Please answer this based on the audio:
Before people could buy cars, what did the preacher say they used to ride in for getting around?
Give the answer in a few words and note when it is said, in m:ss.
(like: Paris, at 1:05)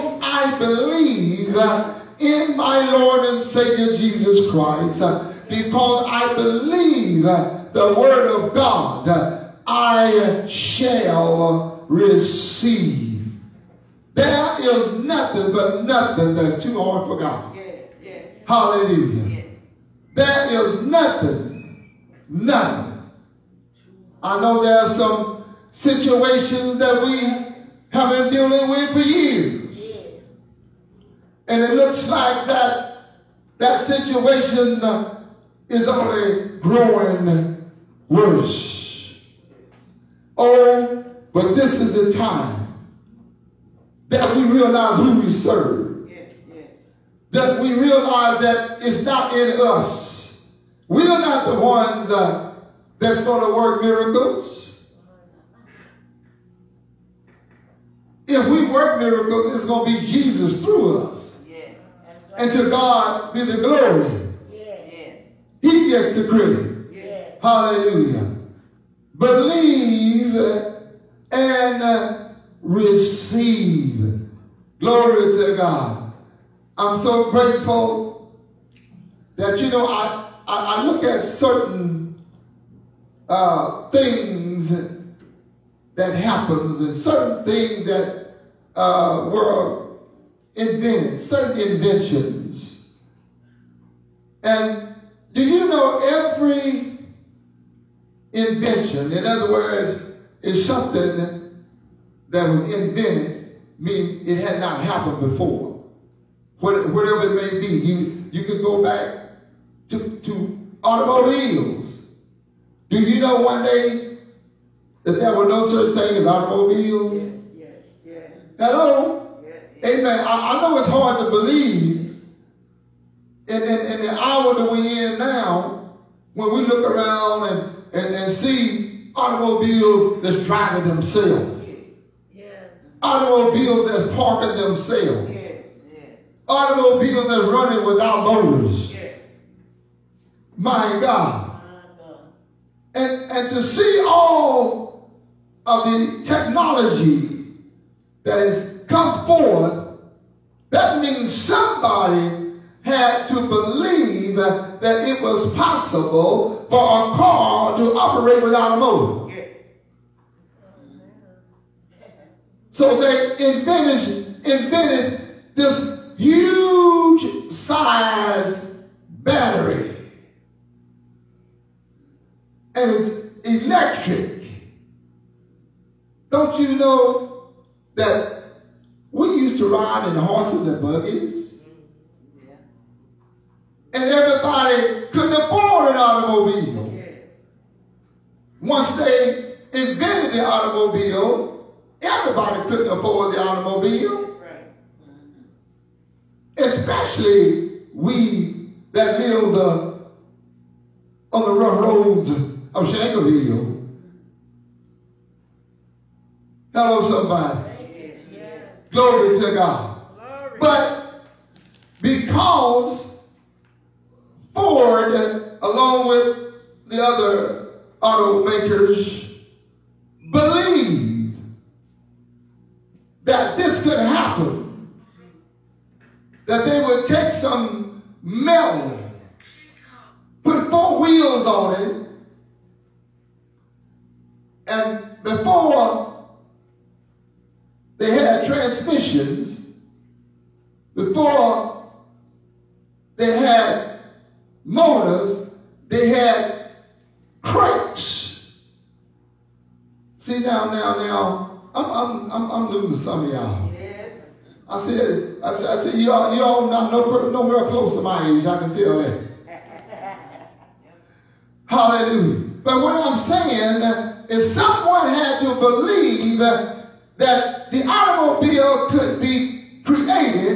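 horses and buggies, at 3:00.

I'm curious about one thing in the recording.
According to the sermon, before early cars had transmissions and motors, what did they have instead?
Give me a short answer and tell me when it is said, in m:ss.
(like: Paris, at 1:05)
cranks, at 4:07.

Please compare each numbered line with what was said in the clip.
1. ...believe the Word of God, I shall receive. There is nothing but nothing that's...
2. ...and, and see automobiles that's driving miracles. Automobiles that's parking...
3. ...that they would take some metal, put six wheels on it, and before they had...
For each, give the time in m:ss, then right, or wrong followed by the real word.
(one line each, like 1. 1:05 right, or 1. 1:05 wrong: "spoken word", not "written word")
1. 0:06 right
2. 2:07 wrong: "themselves", not "miracles"
3. 3:46 wrong: "four", not "six".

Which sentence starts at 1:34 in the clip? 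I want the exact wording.
And do you know every invention, in other words, is something that was invented, mean it had not happened before.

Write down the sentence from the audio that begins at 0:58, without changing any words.
If we work miracles, it's going to be Jesus through us.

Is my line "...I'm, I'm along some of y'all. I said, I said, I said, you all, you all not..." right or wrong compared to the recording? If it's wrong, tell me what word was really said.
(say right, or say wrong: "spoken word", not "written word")
wrong: "losing", not "along".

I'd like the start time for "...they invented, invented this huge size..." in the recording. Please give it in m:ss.
2:42.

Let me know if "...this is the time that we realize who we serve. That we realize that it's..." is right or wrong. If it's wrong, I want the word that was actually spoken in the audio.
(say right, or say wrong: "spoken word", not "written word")
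right.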